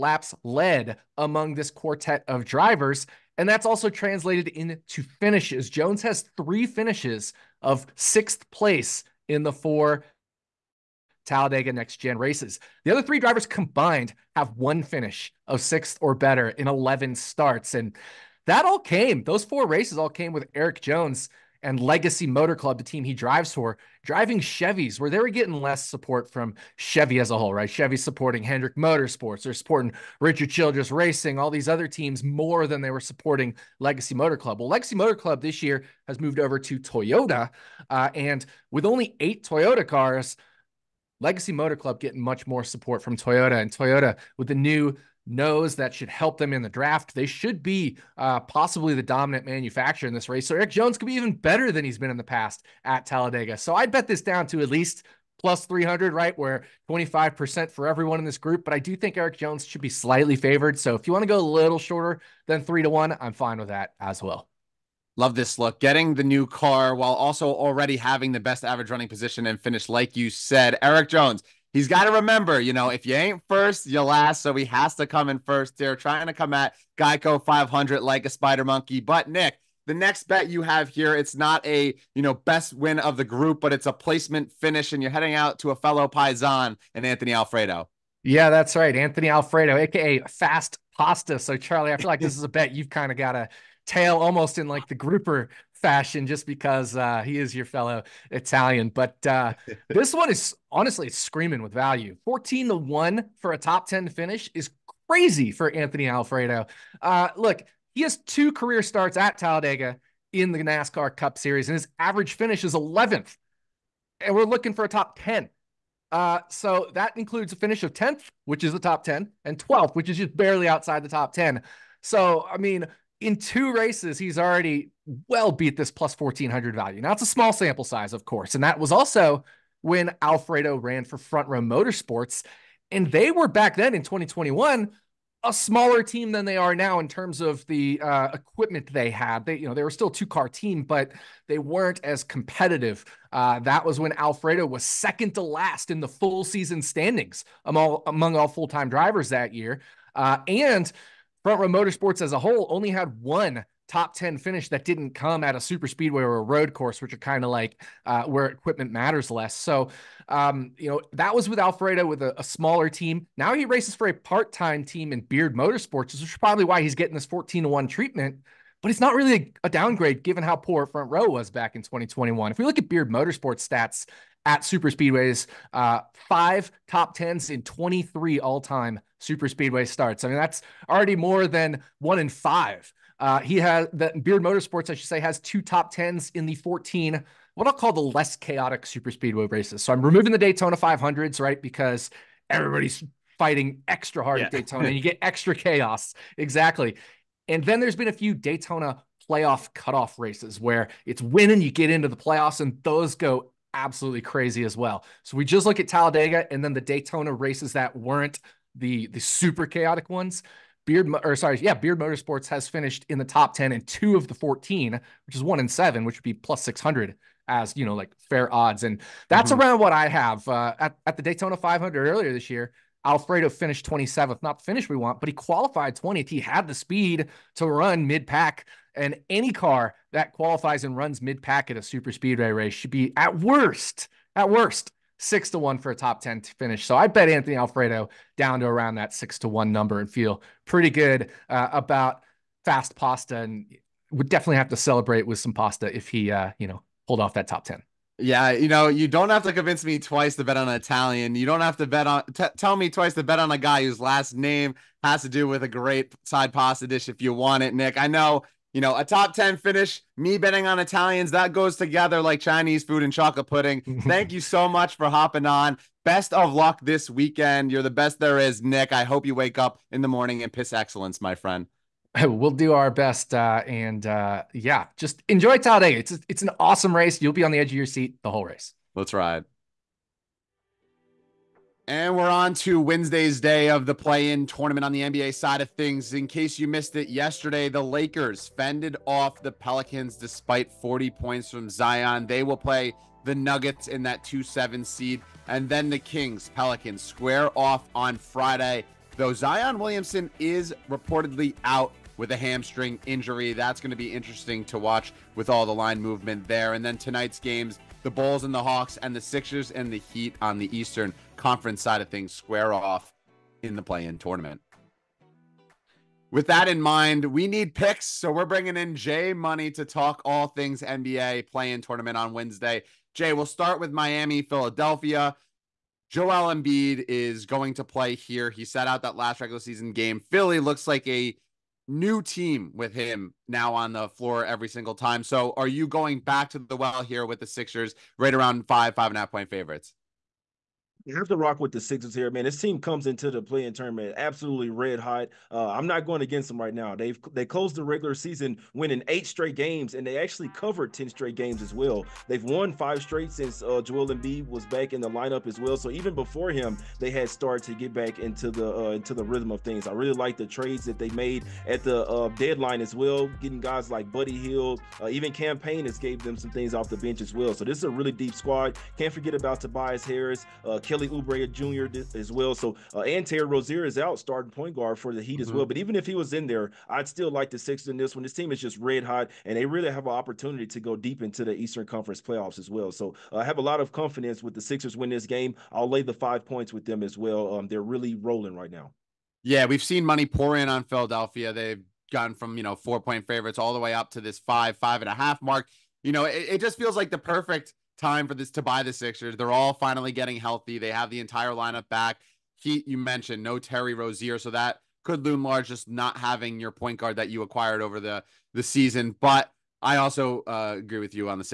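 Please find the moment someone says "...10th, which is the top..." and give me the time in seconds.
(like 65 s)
117 s.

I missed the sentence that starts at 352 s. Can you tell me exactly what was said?
They've won five straight since uh, Joel Embiid was back in the lineup as well.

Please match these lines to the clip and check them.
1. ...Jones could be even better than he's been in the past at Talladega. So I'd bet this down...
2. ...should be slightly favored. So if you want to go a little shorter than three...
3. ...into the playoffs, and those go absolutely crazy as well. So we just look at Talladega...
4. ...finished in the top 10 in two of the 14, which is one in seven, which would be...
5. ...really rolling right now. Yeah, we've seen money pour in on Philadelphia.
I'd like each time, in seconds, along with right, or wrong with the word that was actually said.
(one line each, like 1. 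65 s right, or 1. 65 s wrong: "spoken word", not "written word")
1. 50 s right
2. 59 s right
3. 201 s right
4. 212 s right
5. 387 s right.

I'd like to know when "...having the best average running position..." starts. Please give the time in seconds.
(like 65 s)
67 s.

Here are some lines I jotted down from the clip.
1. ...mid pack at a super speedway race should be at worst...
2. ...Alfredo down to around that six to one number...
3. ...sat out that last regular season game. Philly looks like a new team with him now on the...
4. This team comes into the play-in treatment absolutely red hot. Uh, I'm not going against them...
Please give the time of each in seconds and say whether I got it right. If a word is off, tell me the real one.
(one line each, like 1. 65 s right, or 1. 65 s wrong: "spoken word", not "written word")
1. 231 s right
2. 237 s right
3. 328 s right
4. 342 s wrong: "tournament", not "treatment".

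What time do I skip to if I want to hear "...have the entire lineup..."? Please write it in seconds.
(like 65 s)
400 s.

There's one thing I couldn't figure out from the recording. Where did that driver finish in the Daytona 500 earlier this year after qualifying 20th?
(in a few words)
27th.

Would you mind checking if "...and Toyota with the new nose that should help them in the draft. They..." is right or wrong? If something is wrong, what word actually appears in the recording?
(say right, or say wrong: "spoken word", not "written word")
right.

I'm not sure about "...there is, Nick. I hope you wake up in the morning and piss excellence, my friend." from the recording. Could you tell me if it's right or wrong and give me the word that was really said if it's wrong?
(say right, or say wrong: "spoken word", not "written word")
right.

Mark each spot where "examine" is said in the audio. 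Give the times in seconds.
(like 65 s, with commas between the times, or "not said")
not said.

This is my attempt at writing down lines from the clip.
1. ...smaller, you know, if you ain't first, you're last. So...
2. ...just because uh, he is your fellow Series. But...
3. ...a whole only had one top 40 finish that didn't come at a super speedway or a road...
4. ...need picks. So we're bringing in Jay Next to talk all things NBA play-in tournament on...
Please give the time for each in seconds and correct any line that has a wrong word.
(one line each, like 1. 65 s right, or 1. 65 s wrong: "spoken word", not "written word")
1. 72 s wrong: "remember", not "smaller"
2. 96 s wrong: "Italian", not "Series"
3. 152 s wrong: "10", not "40"
4. 317 s wrong: "Money", not "Next".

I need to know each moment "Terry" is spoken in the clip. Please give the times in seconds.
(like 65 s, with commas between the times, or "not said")
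373 s, 403 s.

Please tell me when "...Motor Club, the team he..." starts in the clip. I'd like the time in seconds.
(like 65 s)
22 s.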